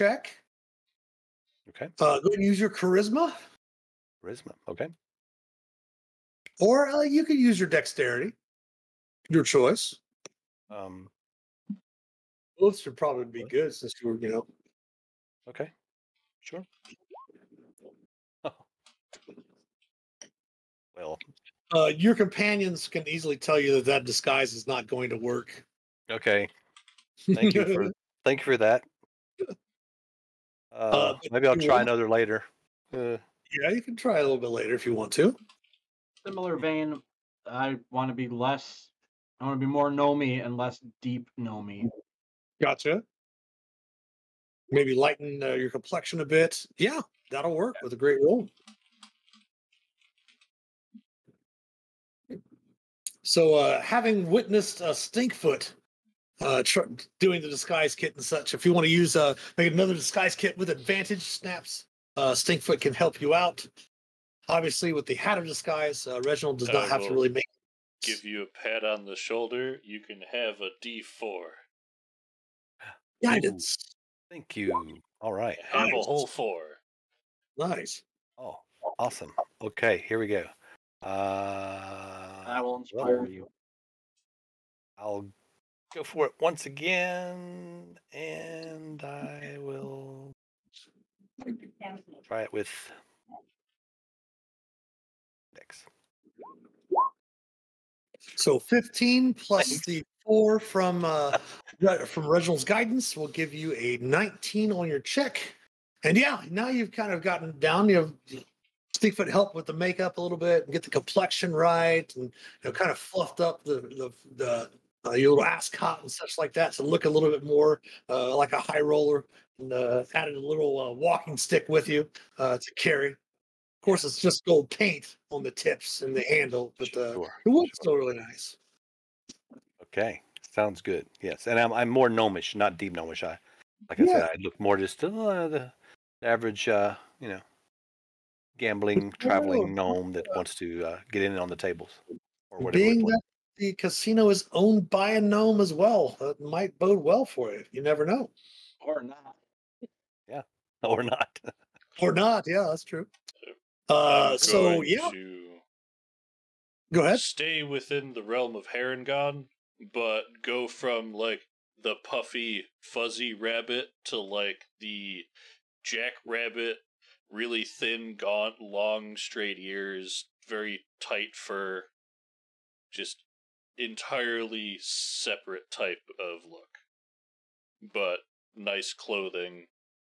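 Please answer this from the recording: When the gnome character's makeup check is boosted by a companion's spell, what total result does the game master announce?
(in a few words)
19.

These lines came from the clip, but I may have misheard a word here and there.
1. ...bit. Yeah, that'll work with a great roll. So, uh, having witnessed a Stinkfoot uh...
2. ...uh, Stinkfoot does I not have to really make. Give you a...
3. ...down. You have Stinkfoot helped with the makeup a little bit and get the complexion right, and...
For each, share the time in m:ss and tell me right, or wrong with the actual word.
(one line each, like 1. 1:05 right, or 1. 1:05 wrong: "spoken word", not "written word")
1. 0:46 right
2. 1:06 wrong: "Reginald", not "Stinkfoot"
3. 1:47 right.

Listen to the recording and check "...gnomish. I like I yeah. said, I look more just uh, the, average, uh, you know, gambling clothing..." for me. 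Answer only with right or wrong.
wrong.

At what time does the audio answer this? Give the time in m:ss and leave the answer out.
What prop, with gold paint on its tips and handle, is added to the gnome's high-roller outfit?
2:00.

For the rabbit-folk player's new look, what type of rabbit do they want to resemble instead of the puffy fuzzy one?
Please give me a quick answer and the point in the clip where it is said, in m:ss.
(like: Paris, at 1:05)
jackrabbit, at 2:45.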